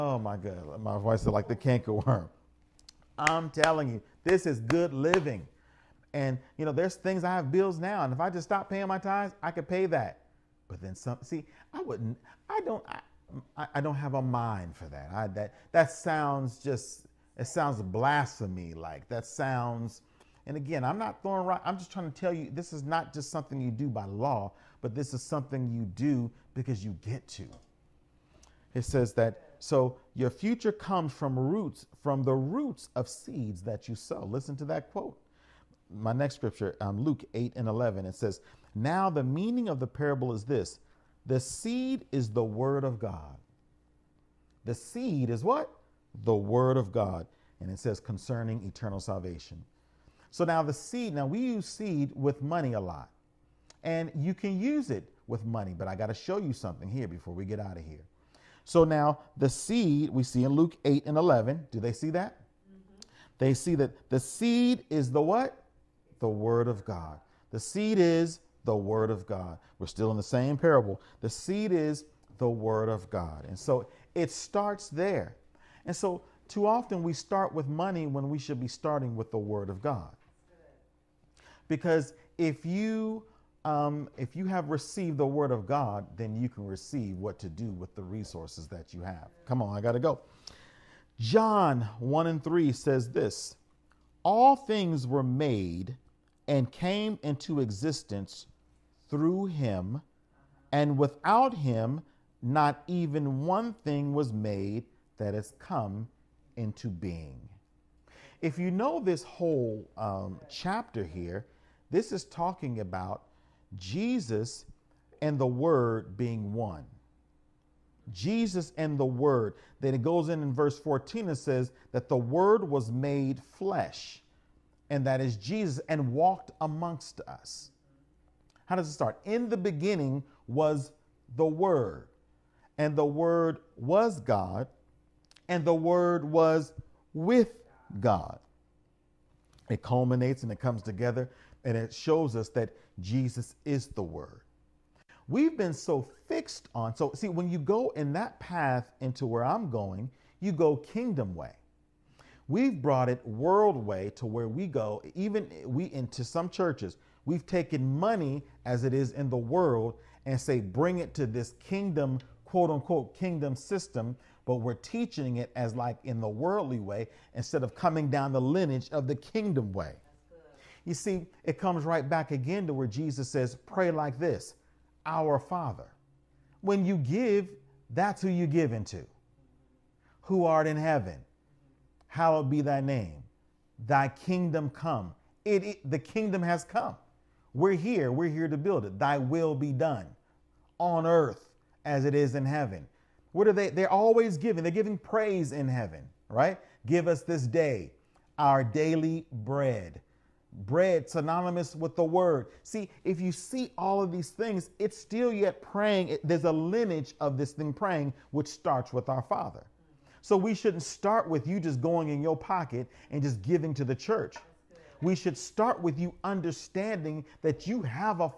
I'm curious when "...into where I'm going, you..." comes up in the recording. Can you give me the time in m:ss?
2:29.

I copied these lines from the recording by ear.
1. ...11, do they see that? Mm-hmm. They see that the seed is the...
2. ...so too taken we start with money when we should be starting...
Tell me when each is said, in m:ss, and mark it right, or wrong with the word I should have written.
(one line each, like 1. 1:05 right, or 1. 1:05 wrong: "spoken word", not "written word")
1. 1:01 right
2. 1:15 wrong: "often", not "taken".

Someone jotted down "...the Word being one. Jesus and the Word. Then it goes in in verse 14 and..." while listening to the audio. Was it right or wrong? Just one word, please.
right.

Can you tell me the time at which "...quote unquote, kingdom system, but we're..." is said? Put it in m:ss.
2:42.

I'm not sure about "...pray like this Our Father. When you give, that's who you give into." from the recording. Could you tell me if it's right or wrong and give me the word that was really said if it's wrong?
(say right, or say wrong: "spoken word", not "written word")
right.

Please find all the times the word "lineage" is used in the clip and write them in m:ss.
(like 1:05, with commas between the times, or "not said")
2:48, 3:26.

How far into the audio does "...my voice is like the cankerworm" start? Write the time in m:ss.
0:00.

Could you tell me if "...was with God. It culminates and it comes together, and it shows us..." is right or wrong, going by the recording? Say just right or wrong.
right.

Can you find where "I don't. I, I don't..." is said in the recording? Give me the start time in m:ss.
0:12.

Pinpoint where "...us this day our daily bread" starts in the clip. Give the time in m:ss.
3:17.